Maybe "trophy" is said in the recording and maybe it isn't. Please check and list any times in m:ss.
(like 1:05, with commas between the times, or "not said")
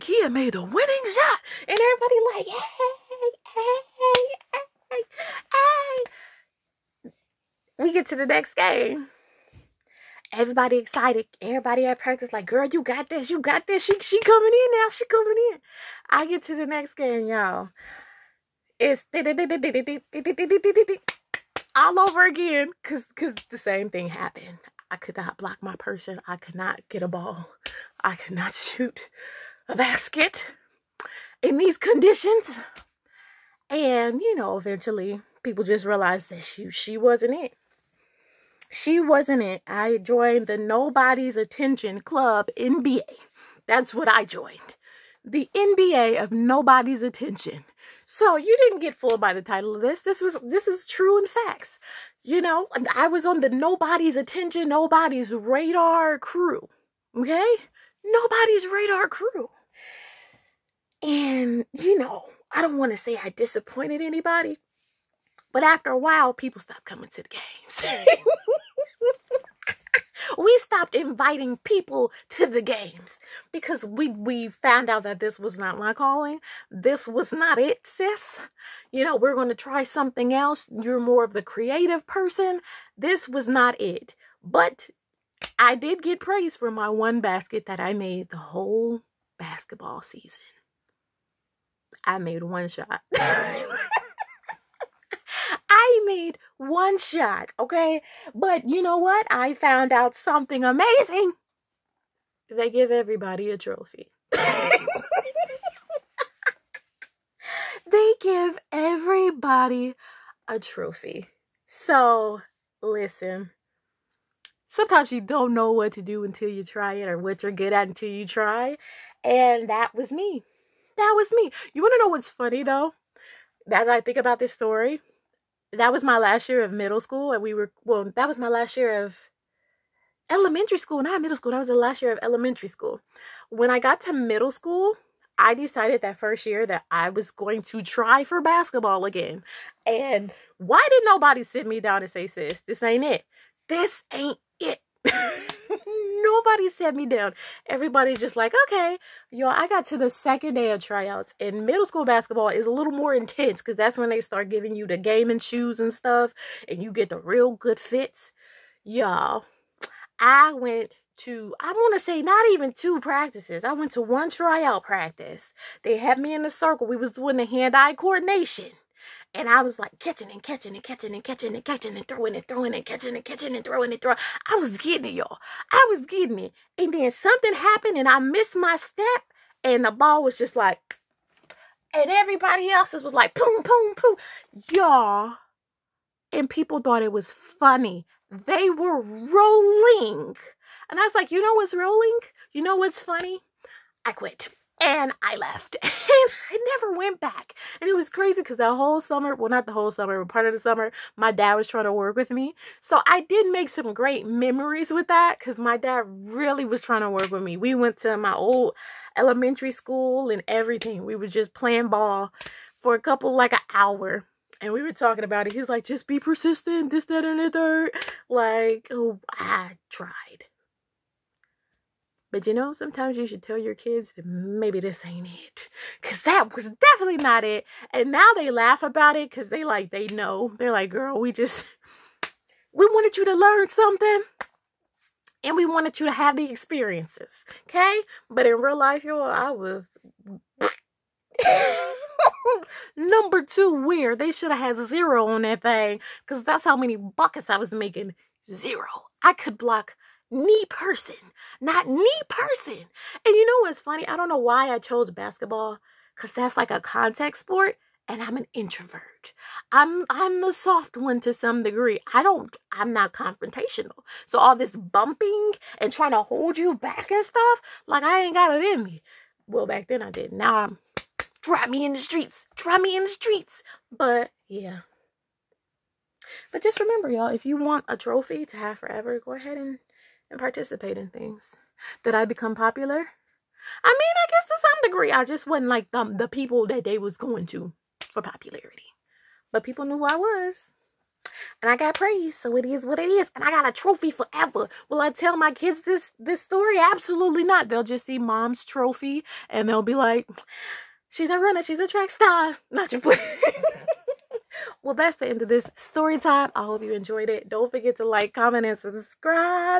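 1:43, 1:50, 4:37, 4:53, 4:58.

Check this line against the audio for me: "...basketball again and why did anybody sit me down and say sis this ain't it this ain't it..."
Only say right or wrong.
wrong.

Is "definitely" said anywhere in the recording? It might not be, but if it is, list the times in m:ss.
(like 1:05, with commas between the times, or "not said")
3:46.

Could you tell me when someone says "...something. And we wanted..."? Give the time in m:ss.
3:53.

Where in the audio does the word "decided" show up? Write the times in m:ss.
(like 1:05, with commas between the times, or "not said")
2:15.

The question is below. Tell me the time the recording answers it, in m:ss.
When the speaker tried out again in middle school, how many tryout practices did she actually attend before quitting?
2:44.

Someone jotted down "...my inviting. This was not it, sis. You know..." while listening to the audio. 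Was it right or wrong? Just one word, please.
wrong.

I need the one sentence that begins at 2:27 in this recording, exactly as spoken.
Everybody's just like, okay, y'all, I got to the second day of tryouts.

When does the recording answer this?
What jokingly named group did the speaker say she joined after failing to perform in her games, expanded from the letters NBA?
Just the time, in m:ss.
0:40.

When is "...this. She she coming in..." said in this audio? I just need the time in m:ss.
0:13.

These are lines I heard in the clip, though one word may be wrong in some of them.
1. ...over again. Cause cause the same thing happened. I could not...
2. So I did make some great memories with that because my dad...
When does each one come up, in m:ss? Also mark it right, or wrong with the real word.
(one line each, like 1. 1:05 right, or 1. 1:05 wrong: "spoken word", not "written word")
1. 0:21 right
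2. 3:22 right.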